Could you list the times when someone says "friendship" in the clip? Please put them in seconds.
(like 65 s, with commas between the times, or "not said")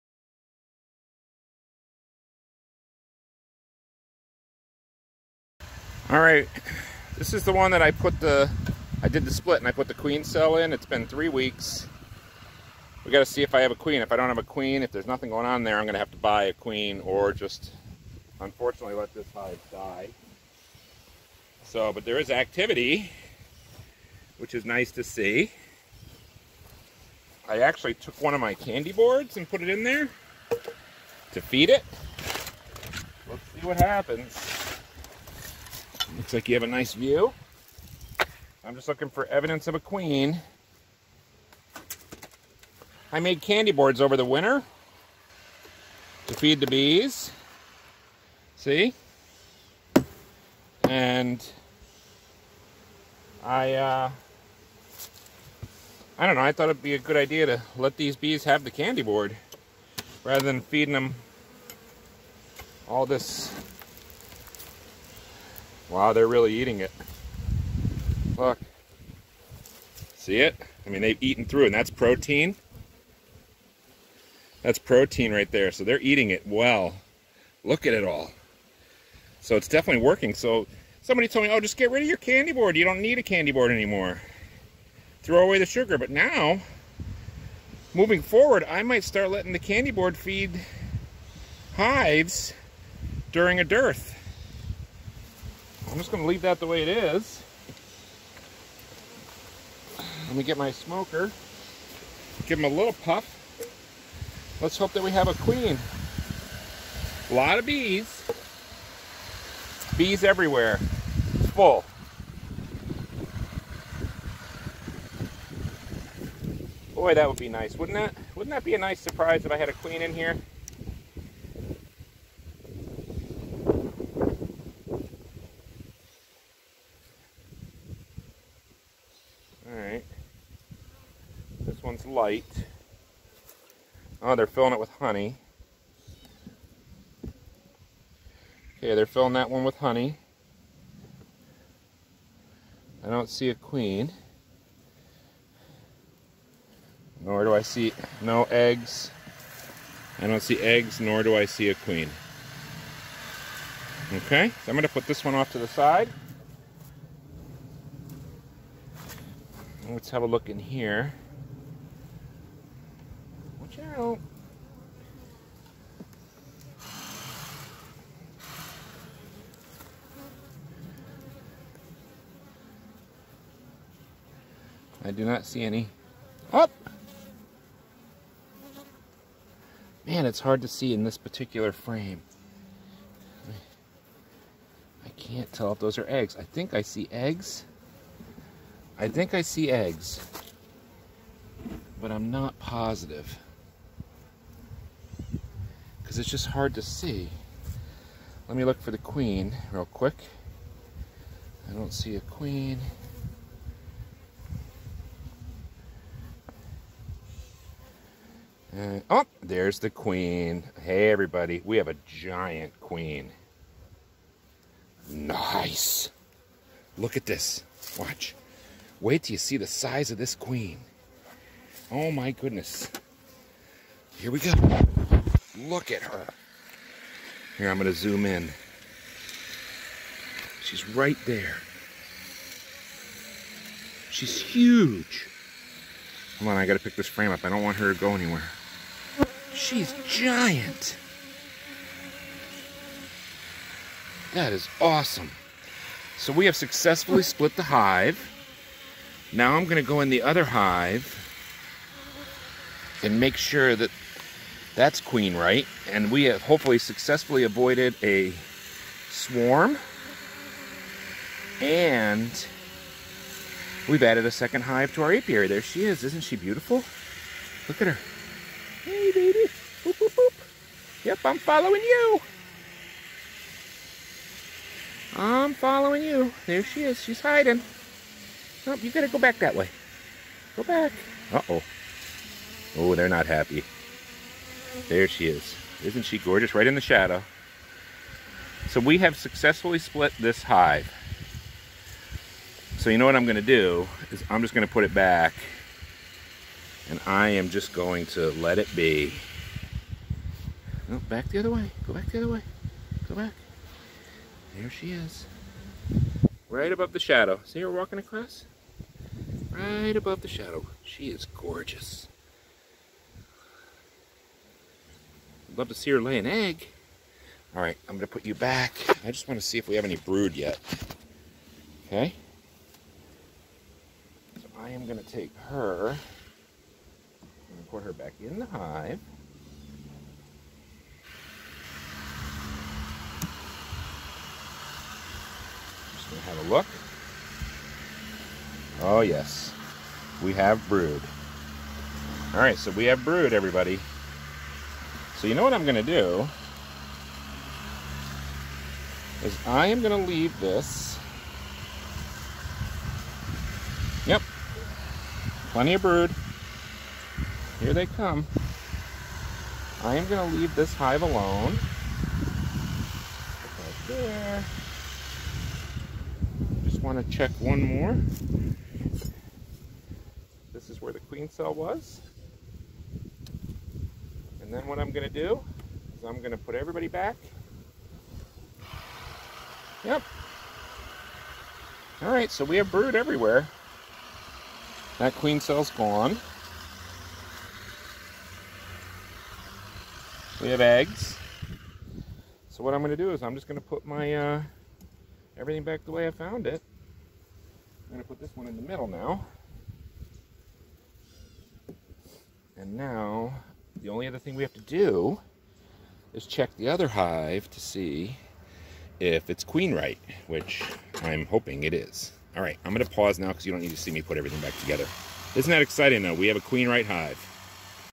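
not said.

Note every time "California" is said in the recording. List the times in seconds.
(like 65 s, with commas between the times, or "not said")
not said.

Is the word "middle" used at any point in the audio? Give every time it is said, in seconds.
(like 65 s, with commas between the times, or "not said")
398 s.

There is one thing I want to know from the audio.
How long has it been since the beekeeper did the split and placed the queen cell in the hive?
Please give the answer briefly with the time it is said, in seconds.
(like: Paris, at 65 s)
3 weeks, at 11 s.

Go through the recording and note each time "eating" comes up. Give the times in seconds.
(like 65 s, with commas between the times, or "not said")
66 s, 75 s.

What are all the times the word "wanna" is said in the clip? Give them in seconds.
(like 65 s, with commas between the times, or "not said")
319 s, 366 s.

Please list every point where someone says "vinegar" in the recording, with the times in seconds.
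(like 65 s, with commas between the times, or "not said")
not said.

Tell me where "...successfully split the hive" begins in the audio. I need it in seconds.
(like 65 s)
246 s.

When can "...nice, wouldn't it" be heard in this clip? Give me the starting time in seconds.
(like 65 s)
117 s.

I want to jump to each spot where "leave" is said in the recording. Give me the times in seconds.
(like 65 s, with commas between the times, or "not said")
96 s, 349 s, 360 s.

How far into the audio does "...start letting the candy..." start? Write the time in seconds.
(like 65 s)
89 s.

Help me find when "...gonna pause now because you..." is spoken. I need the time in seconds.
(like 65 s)
412 s.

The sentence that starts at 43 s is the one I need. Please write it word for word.
I made candy boards over the winter to feed the bees.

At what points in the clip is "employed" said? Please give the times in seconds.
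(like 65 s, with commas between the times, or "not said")
not said.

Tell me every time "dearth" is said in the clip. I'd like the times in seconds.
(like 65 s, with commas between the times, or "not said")
93 s.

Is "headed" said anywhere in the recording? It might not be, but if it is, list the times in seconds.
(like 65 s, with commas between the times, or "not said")
not said.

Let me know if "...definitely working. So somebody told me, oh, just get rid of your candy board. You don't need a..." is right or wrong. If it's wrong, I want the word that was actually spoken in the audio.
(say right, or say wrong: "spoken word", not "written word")
right.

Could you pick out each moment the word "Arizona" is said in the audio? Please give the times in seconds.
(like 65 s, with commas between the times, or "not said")
not said.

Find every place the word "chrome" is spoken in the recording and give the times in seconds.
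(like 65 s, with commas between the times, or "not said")
not said.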